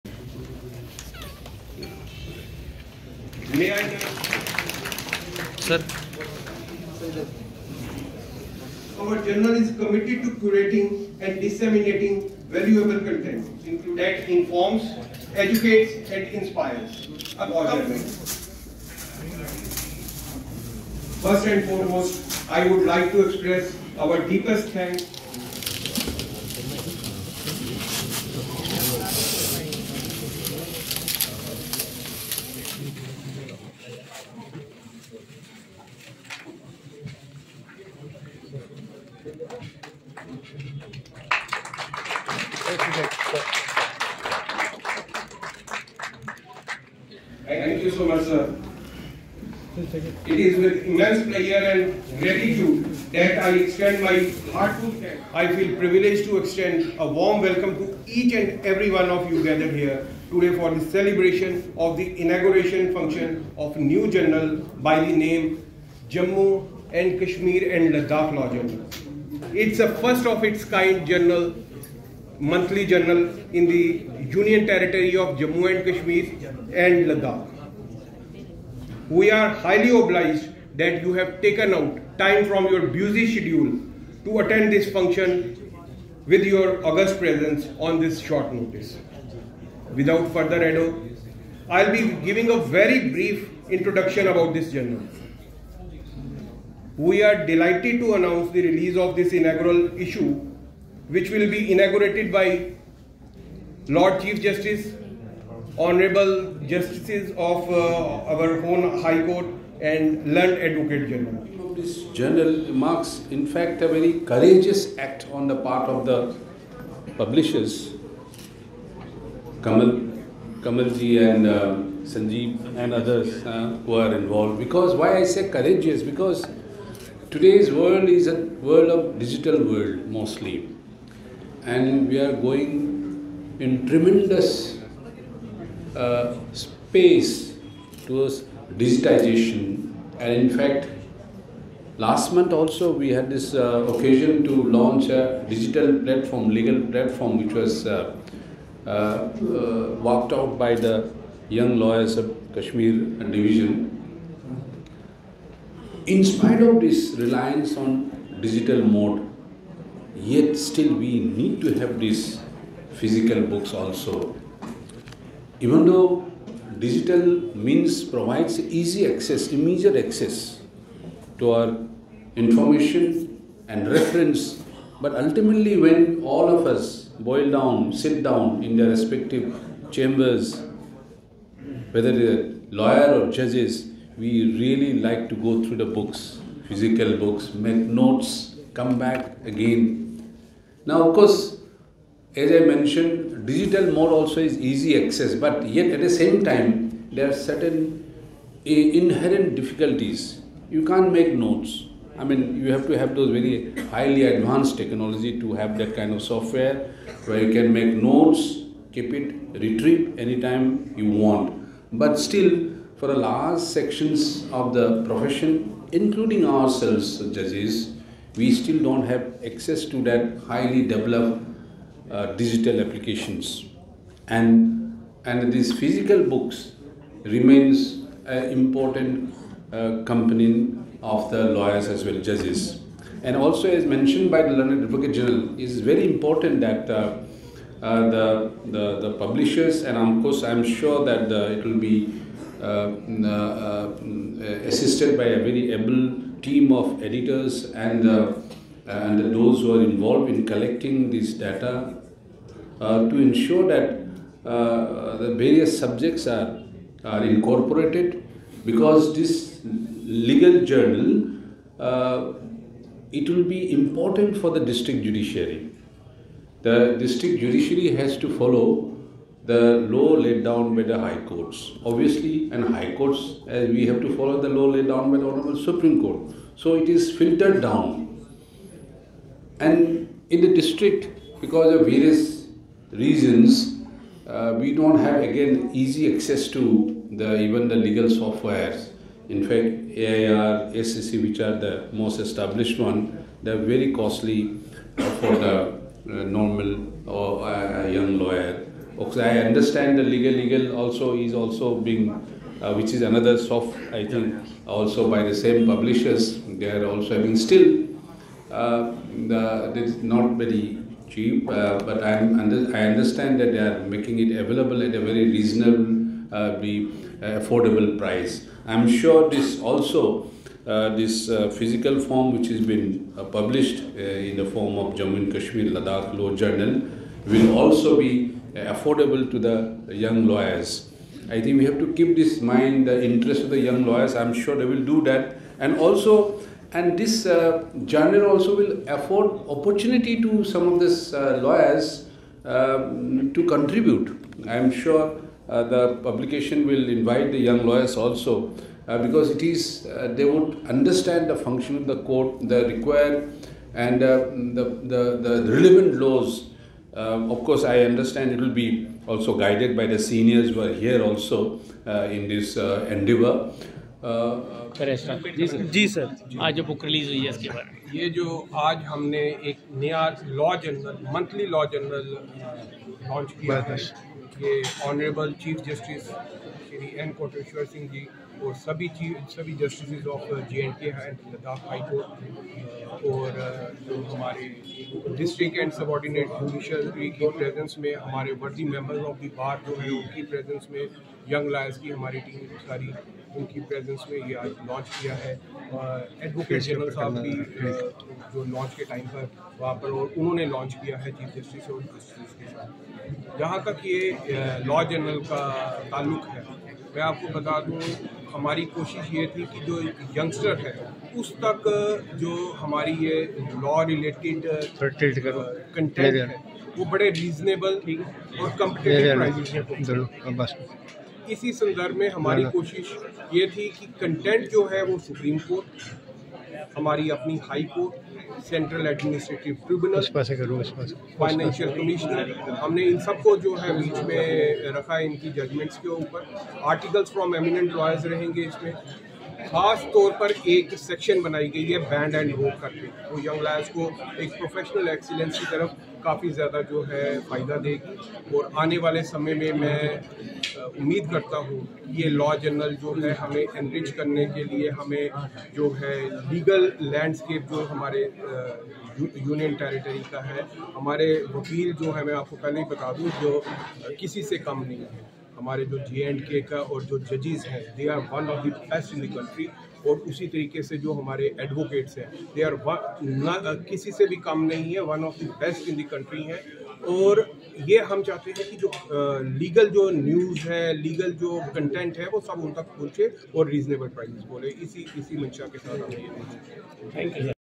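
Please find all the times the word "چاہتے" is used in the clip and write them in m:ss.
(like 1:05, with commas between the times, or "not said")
7:58.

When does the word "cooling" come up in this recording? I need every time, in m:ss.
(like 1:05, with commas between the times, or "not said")
not said.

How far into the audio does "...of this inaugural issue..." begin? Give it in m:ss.
1:38.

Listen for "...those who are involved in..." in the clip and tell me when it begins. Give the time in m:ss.
4:09.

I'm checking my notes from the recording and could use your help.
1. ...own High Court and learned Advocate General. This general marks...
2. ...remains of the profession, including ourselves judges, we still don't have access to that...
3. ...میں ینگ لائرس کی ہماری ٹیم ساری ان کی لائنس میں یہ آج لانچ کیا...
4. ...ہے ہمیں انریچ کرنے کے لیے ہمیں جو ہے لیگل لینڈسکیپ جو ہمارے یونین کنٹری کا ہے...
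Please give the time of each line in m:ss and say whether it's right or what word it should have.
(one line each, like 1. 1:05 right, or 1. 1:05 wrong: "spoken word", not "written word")
1. 1:48 right
2. 3:33 wrong: "sections", not "remains"
3. 6:30 wrong: "پریزنس", not "لائنس"
4. 7:33 wrong: "ٹیریٹری", not "کنٹری".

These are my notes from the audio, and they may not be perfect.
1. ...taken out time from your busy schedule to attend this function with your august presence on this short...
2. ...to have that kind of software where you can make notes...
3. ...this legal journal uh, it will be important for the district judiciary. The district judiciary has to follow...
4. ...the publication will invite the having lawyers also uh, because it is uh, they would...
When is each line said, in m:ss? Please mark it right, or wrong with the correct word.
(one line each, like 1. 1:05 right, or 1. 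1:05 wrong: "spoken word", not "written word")
1. 1:21 right
2. 3:25 right
3. 4:19 right
4. 5:45 wrong: "young", not "having".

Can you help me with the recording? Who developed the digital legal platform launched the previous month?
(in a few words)
Young lawyers of Kashmir.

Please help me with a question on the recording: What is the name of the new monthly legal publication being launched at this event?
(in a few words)
Jammu and Kashmir and Ladakh Law Journal.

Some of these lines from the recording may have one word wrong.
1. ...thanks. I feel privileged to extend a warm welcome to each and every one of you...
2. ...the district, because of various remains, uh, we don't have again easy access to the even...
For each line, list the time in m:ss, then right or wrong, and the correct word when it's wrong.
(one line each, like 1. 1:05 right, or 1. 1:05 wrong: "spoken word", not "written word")
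1. 0:55 right
2. 4:40 wrong: "reasons", not "remains".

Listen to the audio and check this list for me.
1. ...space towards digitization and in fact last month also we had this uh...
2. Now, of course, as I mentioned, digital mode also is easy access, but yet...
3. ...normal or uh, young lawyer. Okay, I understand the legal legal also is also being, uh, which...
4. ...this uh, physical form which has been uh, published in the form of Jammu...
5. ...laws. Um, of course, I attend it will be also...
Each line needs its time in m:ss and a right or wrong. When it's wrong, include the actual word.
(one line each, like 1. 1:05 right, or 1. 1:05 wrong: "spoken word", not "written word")
1. 2:16 right
2. 3:10 right
3. 4:56 right
4. 5:20 right
5. 5:55 wrong: "understand", not "attend".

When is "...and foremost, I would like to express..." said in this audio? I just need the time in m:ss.
0:21.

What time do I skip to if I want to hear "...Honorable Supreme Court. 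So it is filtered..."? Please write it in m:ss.
4:35.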